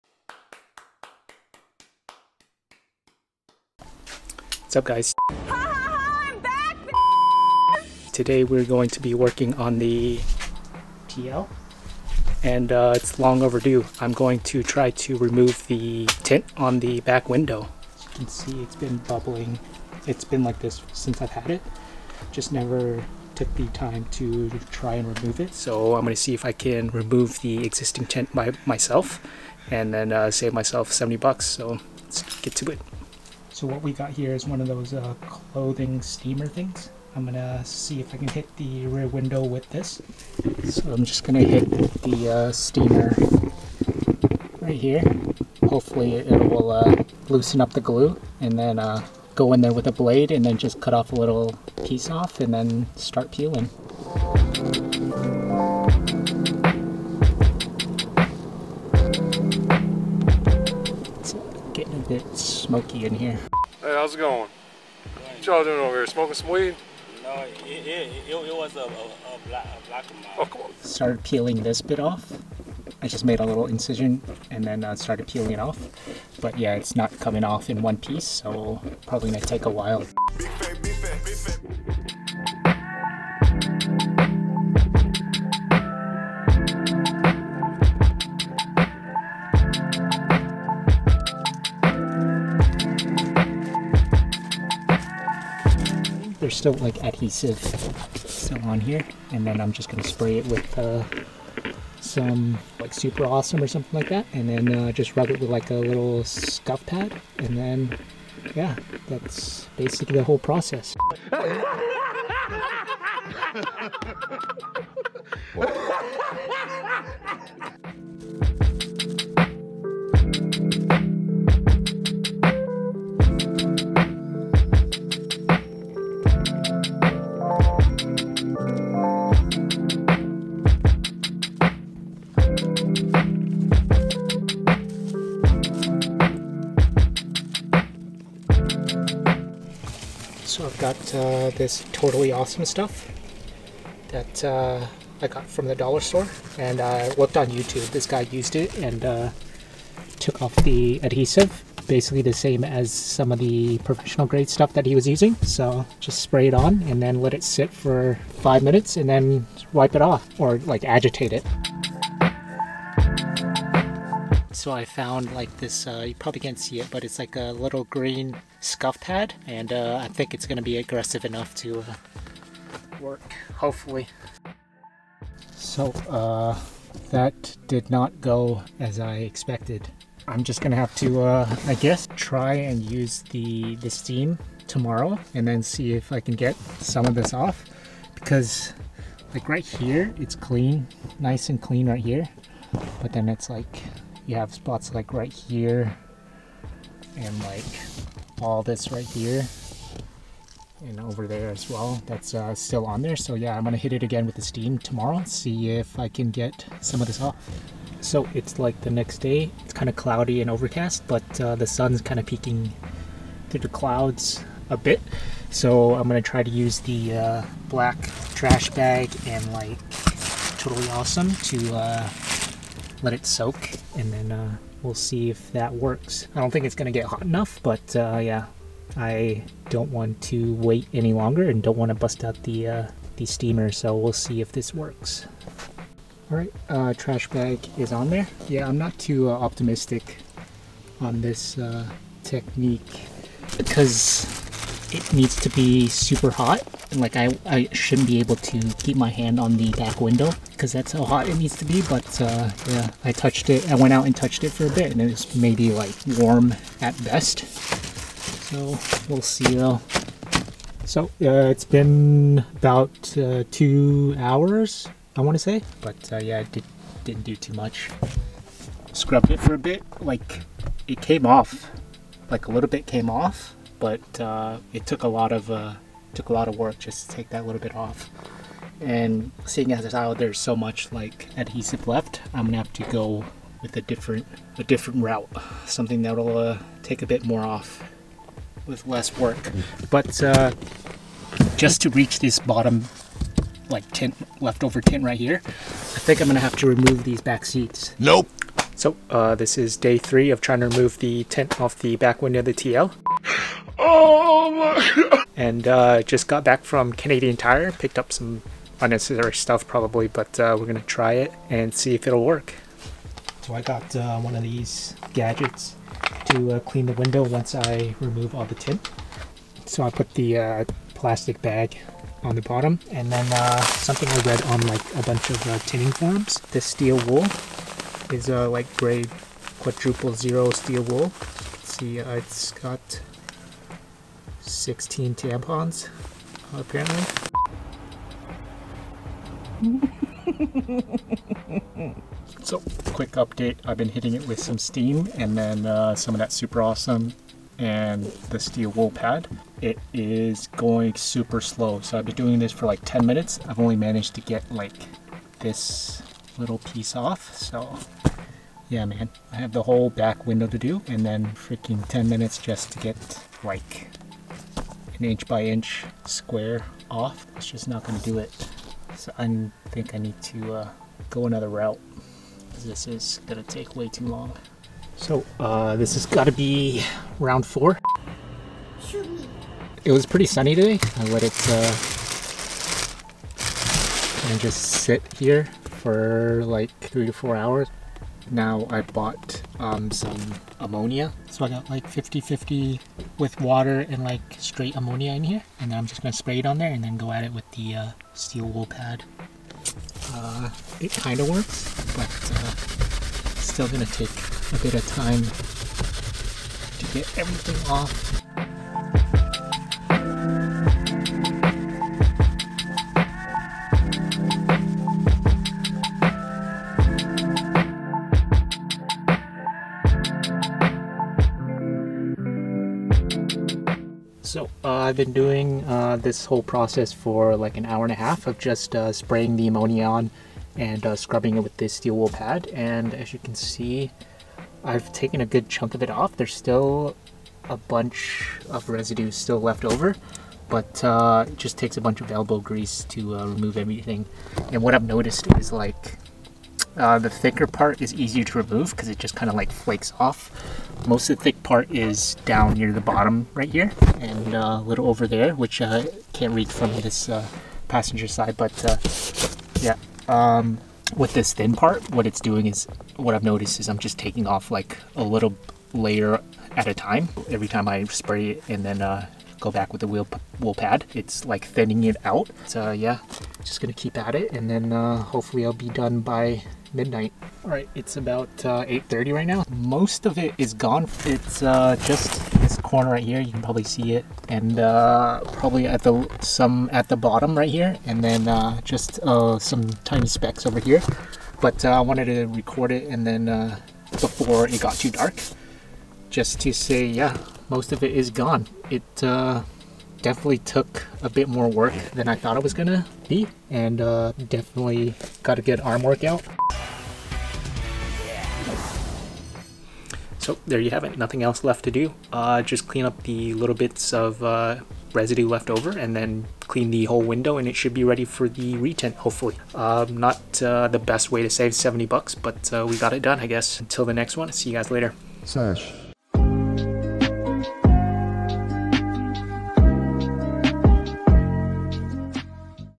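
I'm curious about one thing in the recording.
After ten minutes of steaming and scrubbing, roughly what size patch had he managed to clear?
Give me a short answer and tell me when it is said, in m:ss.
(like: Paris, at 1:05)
inch by inch, at 6:05.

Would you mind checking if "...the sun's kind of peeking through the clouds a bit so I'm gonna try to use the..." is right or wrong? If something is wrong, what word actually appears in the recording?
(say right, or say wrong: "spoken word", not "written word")
right.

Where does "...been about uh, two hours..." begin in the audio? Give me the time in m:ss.
4:21.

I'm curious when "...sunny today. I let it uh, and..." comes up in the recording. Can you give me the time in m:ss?
6:20.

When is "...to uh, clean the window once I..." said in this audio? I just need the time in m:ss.
5:16.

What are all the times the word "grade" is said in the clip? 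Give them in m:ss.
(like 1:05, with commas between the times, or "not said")
2:34, 5:28.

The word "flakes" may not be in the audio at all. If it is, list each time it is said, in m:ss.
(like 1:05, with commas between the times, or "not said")
7:29.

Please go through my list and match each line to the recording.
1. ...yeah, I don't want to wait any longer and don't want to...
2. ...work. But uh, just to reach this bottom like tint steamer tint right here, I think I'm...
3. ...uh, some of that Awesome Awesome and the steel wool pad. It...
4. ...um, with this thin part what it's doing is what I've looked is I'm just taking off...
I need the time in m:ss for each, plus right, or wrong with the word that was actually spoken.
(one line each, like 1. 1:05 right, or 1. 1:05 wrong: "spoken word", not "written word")
1. 3:48 right
2. 4:49 wrong: "leftover", not "steamer"
3. 5:45 wrong: "Super", not "Awesome"
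4. 7:40 wrong: "noticed", not "looked".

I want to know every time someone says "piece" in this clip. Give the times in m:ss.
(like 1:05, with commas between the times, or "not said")
0:51, 1:17, 5:56.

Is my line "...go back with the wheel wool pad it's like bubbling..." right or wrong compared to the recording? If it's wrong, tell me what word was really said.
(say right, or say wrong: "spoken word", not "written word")
wrong: "thinning", not "bubbling".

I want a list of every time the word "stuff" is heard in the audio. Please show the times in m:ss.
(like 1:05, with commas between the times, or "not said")
2:22, 2:34, 5:09.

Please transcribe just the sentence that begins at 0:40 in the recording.
So I'm just gonna hit the uh, steamer right here.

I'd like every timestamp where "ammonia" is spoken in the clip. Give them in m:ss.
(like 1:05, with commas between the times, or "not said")
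6:30, 6:34, 7:09.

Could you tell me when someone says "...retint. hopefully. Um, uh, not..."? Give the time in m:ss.
8:38.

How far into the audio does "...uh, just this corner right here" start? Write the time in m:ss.
8:01.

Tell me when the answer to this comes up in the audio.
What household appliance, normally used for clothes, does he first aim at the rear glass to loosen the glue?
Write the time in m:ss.
0:35.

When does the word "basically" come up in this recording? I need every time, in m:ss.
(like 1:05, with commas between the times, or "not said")
1:49, 2:31.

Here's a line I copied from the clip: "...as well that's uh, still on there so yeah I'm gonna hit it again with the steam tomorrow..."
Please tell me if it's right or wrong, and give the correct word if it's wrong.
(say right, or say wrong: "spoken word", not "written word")
right.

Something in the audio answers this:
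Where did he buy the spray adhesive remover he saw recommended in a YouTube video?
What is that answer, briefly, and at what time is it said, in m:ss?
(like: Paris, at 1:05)
dollar store, at 2:25.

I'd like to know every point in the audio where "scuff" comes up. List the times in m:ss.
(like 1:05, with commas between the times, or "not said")
1:46, 2:48.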